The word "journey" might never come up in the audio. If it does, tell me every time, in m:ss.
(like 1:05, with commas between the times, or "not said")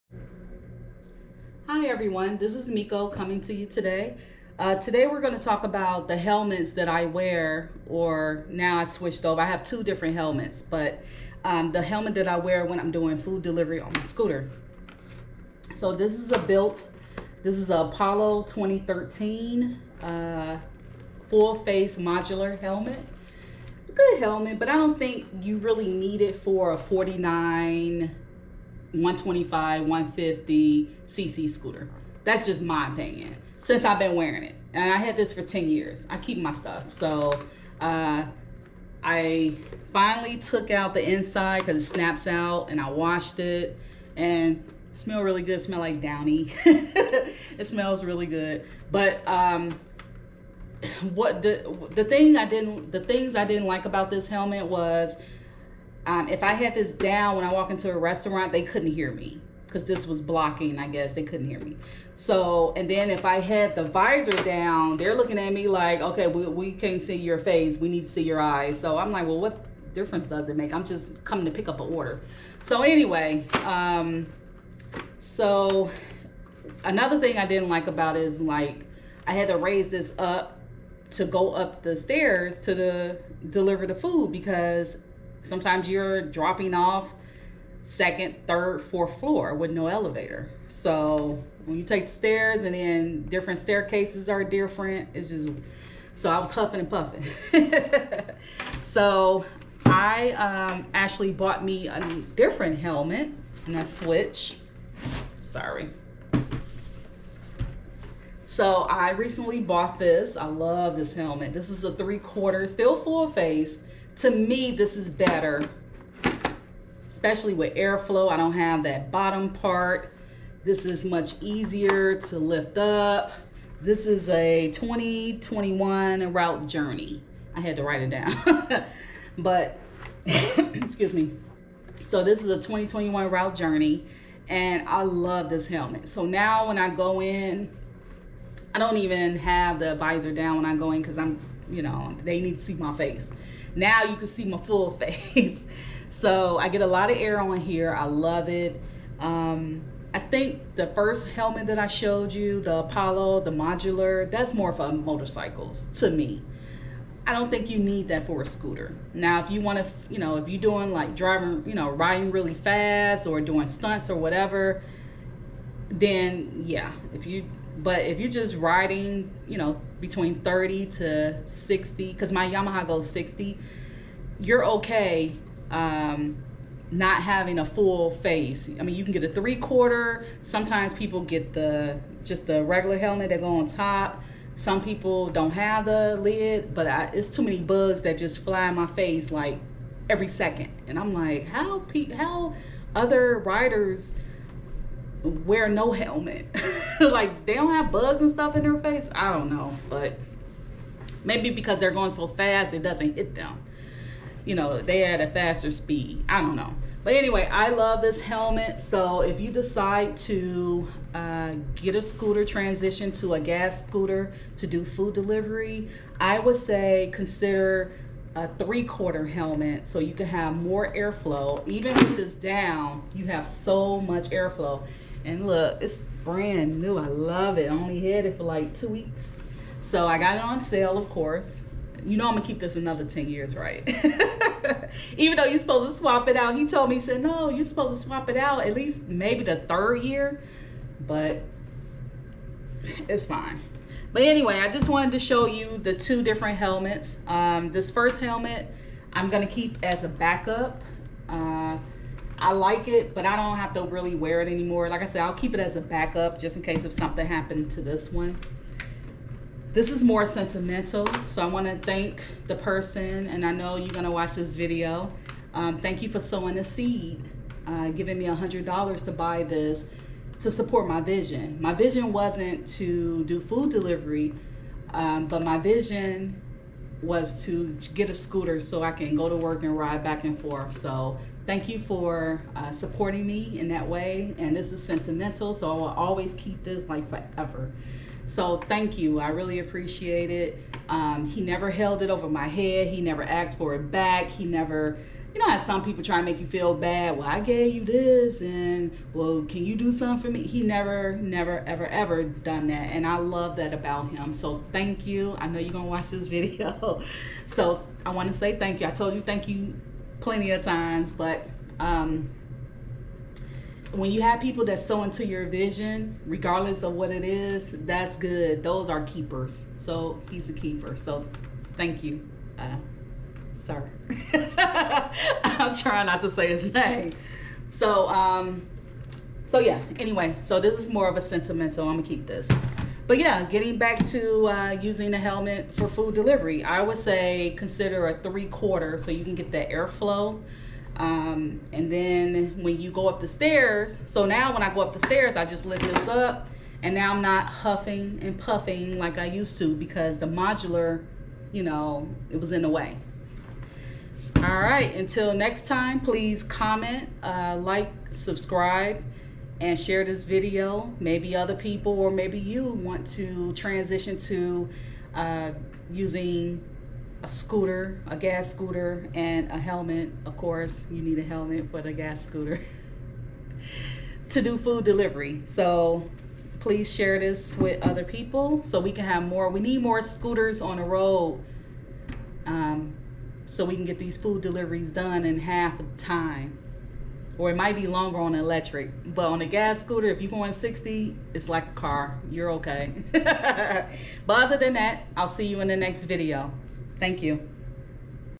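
2:06, 2:13.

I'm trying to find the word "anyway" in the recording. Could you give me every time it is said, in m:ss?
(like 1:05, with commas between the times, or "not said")
1:12, 3:27, 4:04, 5:29.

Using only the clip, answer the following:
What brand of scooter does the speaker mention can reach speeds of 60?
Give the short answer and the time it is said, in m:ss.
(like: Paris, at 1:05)
Yamaha, at 2:52.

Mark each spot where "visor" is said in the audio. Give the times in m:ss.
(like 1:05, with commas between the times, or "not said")
1:03, 2:19.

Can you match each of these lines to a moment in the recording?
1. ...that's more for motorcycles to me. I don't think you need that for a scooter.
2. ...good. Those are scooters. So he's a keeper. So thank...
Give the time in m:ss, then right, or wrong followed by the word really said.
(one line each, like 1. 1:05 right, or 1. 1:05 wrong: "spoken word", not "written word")
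1. 2:34 right
2. 5:18 wrong: "keepers", not "scooters".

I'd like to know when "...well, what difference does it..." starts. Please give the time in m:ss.
1:09.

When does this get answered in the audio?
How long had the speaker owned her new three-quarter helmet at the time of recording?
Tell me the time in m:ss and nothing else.
3:48.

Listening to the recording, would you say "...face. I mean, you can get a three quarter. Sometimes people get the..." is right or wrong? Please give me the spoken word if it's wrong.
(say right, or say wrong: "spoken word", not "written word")
right.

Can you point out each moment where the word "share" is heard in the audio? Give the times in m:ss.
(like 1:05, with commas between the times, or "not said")
5:59, 6:16.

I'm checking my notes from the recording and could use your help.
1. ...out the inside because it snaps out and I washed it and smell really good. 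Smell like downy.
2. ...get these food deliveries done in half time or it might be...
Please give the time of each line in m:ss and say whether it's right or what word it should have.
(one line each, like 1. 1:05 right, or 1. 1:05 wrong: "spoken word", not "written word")
1. 0:40 right
2. 6:23 right.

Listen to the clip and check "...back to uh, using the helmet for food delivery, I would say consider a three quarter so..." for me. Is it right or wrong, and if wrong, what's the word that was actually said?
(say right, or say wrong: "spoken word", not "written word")
right.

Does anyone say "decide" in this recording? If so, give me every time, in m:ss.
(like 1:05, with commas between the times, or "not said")
3:29.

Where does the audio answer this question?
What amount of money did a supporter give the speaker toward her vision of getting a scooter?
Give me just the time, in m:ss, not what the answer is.
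4:28.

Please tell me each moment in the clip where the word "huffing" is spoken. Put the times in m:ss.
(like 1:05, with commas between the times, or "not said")
1:36, 5:47.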